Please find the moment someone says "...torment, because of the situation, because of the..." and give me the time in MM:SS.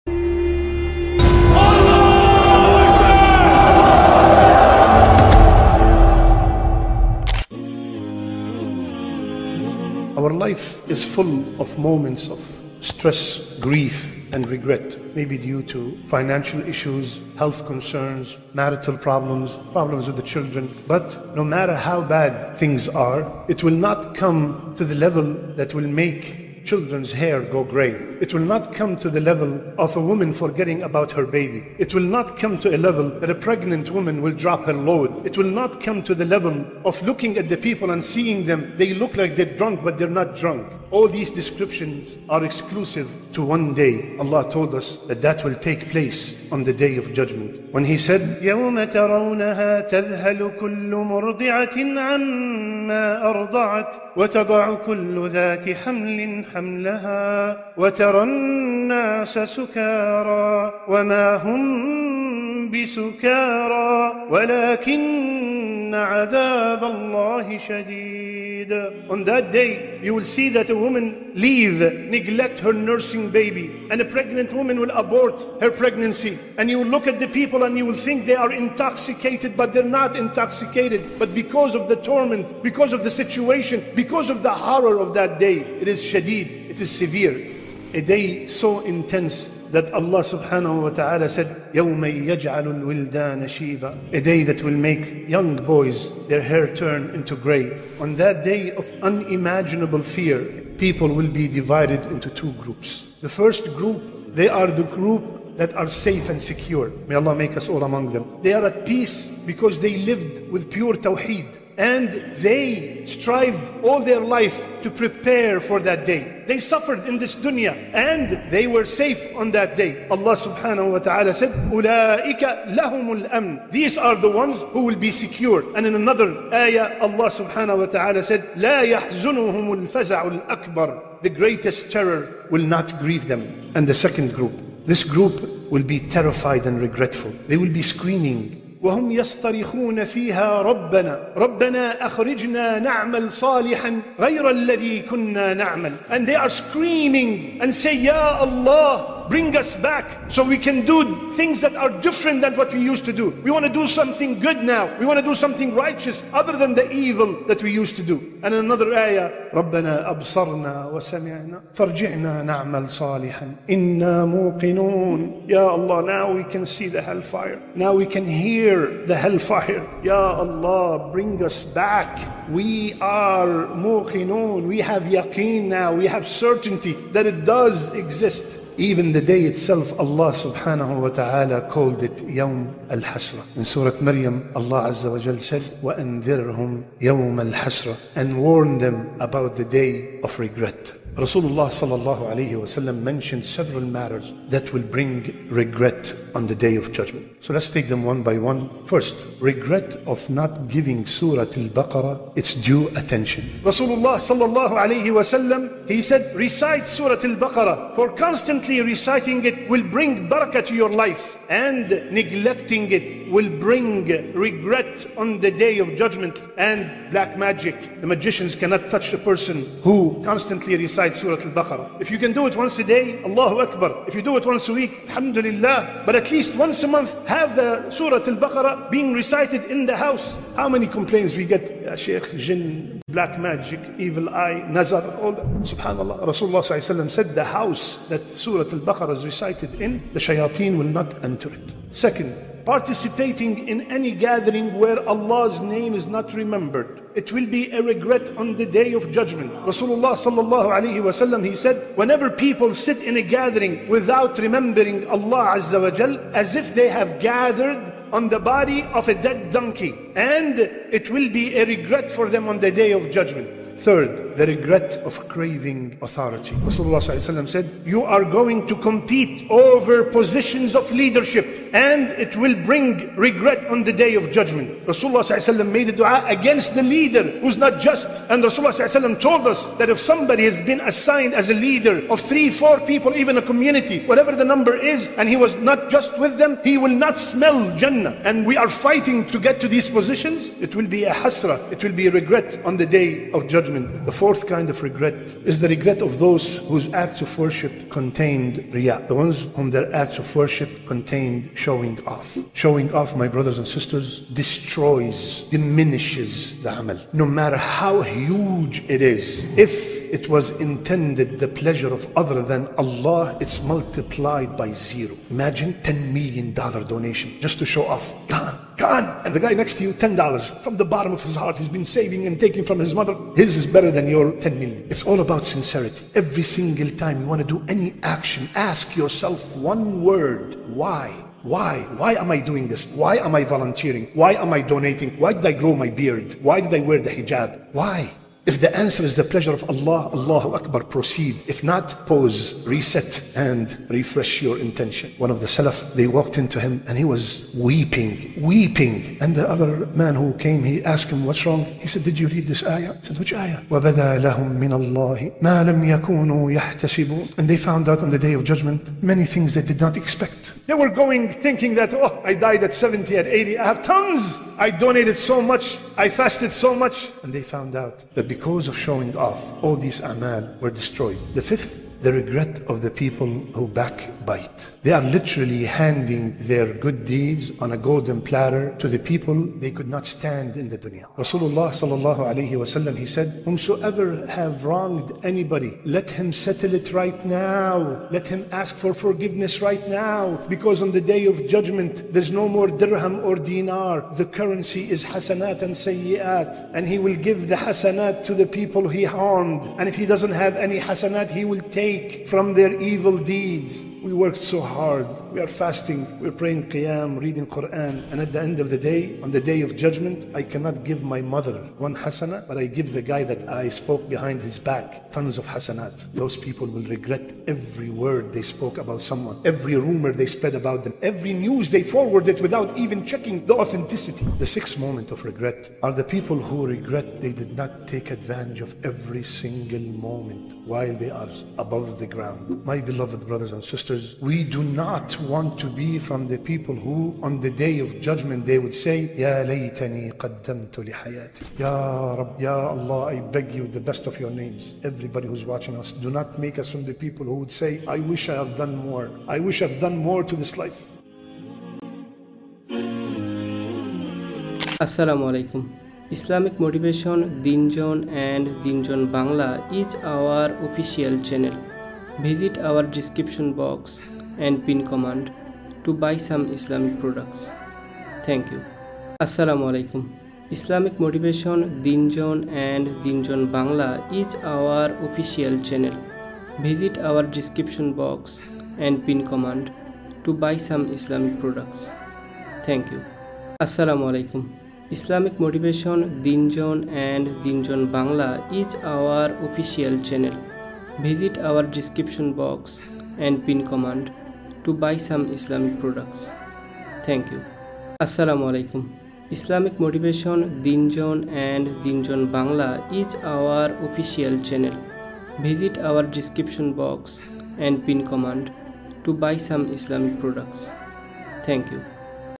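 01:21.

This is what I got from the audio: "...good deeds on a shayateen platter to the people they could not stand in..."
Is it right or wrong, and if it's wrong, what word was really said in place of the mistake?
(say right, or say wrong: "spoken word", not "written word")
wrong: "golden", not "shayateen".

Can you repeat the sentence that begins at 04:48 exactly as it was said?
And we are fighting to get to these positions.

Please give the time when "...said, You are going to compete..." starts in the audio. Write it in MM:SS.
04:27.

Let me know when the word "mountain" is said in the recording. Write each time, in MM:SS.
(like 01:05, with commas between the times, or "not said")
not said.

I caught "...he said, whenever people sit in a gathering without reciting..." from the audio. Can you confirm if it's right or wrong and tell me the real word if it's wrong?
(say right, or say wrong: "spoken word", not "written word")
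wrong: "remembering", not "reciting".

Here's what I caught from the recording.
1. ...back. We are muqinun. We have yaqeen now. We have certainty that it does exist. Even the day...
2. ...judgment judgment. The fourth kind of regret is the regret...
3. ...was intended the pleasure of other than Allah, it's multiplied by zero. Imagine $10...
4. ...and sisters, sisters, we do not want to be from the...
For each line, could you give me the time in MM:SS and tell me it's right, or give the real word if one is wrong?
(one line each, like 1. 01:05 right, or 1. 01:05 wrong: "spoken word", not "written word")
1. 02:51 right
2. 04:53 right
3. 05:10 right
4. 07:13 right.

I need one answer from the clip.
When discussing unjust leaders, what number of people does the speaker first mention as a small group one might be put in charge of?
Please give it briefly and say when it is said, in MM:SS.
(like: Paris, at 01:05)
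three, at 04:42.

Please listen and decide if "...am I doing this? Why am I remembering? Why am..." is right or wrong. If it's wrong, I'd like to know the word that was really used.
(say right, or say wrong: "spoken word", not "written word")
wrong: "volunteering", not "remembering".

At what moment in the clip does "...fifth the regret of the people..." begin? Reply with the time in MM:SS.
06:11.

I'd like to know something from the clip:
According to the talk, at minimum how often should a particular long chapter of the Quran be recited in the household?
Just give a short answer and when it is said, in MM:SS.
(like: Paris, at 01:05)
once a month, at 03:46.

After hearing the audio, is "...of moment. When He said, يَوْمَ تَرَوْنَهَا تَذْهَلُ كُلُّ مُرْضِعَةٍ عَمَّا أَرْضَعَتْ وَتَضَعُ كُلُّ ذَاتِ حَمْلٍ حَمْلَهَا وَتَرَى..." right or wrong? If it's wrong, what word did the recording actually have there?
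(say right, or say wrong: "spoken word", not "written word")
wrong: "judgment", not "moment".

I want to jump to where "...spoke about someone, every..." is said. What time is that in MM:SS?
06:58.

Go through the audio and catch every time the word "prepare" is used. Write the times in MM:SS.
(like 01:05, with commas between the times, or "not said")
01:54.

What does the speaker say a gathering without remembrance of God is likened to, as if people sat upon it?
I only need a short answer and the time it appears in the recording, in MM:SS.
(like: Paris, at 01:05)
body of a dead donkey, at 04:18.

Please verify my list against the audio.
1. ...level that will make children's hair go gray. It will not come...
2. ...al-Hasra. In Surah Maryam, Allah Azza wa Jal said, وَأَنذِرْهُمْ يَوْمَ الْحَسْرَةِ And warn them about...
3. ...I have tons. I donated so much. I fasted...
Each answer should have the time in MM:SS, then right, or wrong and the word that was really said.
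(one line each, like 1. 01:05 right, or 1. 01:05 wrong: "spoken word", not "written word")
1. 00:24 right
2. 03:02 right
3. 06:03 right.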